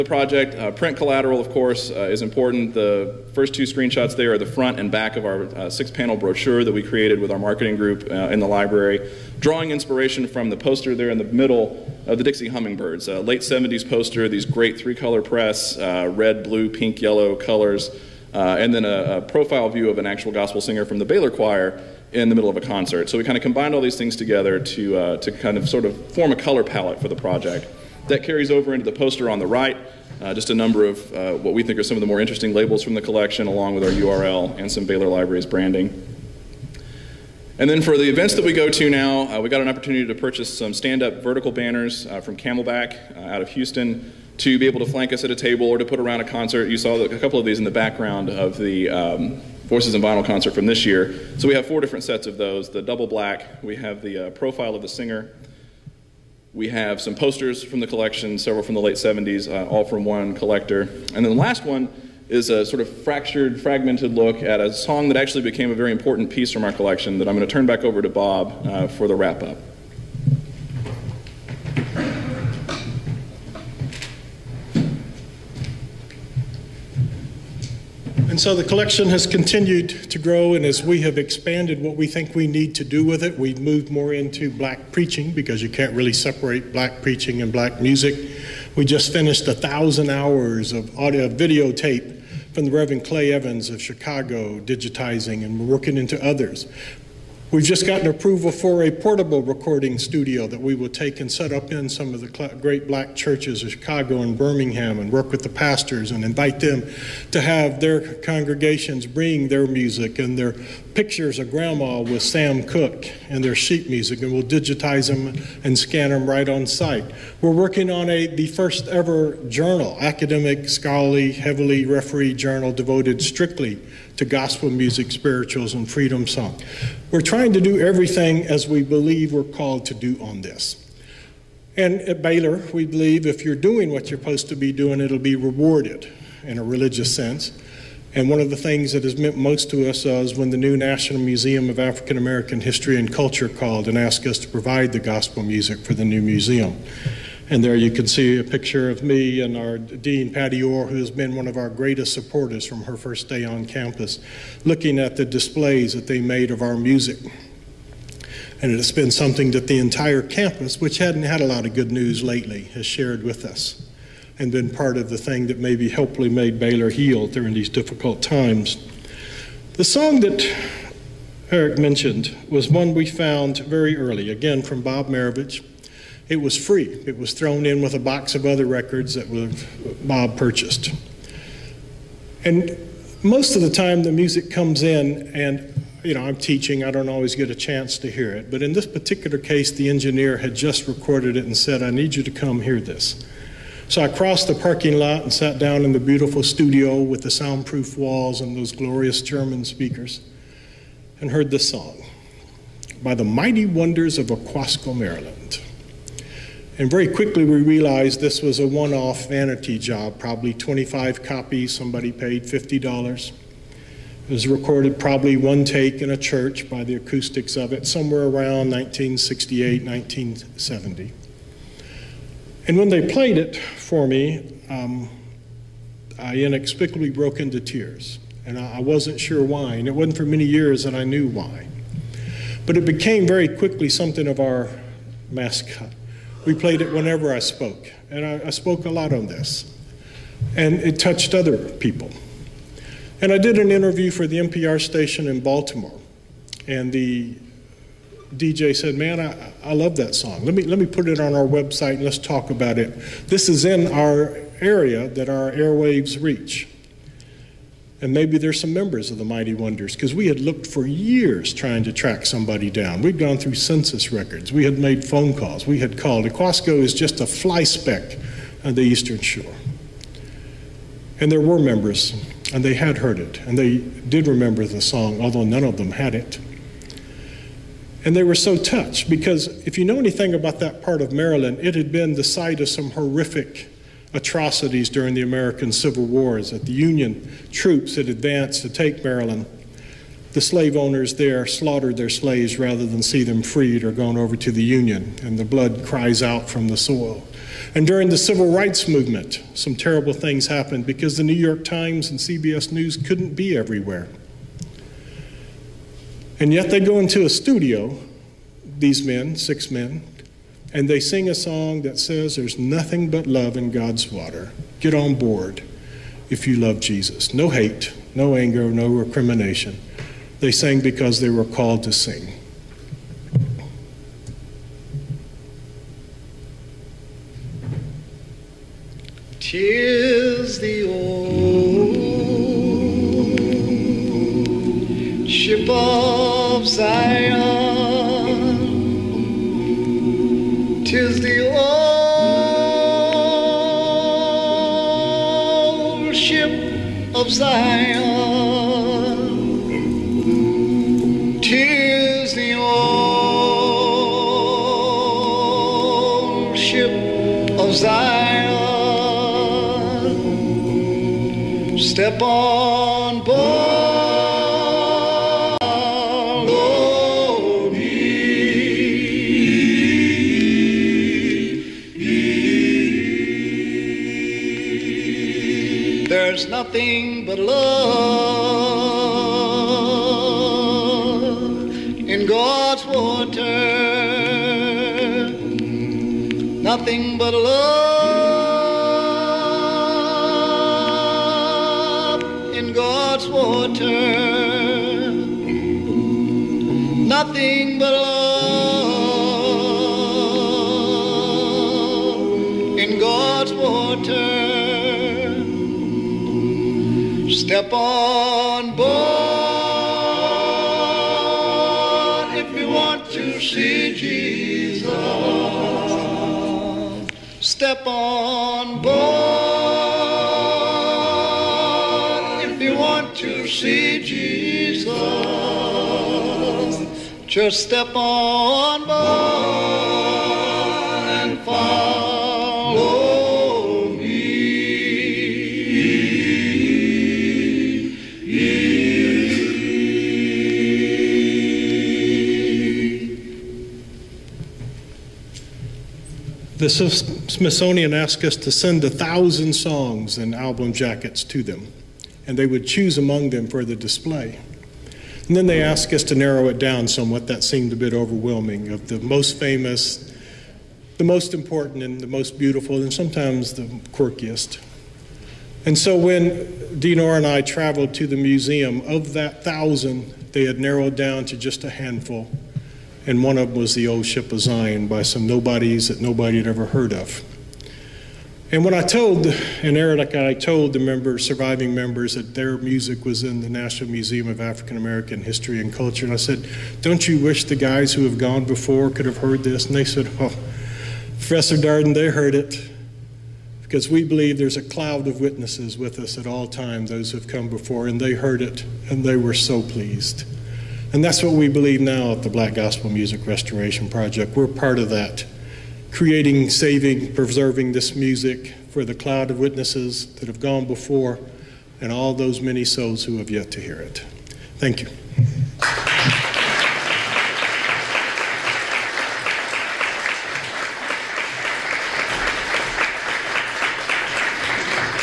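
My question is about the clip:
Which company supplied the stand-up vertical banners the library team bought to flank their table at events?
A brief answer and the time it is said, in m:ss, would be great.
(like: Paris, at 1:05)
Camelback, at 0:42.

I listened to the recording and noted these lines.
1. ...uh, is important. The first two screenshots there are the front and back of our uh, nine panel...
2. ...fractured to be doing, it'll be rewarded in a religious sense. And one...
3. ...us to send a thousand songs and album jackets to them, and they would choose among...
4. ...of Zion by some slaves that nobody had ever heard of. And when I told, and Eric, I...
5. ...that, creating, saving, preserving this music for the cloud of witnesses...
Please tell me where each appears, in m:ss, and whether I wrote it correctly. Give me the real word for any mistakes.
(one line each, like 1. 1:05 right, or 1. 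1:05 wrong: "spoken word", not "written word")
1. 0:01 wrong: "six", not "nine"
2. 2:14 wrong: "supposed", not "fractured"
3. 7:28 right
4. 7:54 wrong: "nobodies", not "slaves"
5. 8:24 right.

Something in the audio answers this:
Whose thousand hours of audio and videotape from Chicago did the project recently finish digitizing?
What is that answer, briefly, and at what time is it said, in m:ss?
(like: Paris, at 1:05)
Reverend Clay Evans, at 1:32.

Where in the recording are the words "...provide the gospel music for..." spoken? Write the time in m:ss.
2:24.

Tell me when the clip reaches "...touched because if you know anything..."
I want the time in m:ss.
4:38.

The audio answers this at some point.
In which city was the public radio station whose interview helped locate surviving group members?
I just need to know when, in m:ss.
4:05.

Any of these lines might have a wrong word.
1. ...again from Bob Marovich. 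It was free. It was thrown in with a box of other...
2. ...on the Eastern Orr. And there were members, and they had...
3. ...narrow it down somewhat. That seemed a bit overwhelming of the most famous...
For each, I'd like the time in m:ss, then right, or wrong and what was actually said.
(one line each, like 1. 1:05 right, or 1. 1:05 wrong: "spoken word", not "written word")
1. 2:54 right
2. 4:28 wrong: "Shore", not "Orr"
3. 7:36 right.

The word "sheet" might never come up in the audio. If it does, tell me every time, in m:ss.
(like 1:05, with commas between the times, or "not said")
1:53.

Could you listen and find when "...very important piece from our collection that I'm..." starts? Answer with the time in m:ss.
1:05.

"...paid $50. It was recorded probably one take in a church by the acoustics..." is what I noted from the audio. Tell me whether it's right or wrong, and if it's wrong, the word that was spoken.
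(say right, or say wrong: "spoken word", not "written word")
right.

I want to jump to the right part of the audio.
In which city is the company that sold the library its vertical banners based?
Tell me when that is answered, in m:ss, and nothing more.
0:43.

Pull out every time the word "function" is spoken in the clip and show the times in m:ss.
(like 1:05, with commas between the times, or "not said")
not said.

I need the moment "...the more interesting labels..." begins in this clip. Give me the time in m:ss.
0:32.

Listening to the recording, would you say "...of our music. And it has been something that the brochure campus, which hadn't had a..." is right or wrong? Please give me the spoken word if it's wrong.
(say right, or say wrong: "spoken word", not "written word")
wrong: "entire", not "brochure".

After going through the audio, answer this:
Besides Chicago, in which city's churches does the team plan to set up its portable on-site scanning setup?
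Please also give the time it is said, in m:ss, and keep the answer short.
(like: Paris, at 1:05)
Birmingham, at 1:44.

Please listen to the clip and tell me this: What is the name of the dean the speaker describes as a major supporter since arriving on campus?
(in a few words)
Pattie Orr.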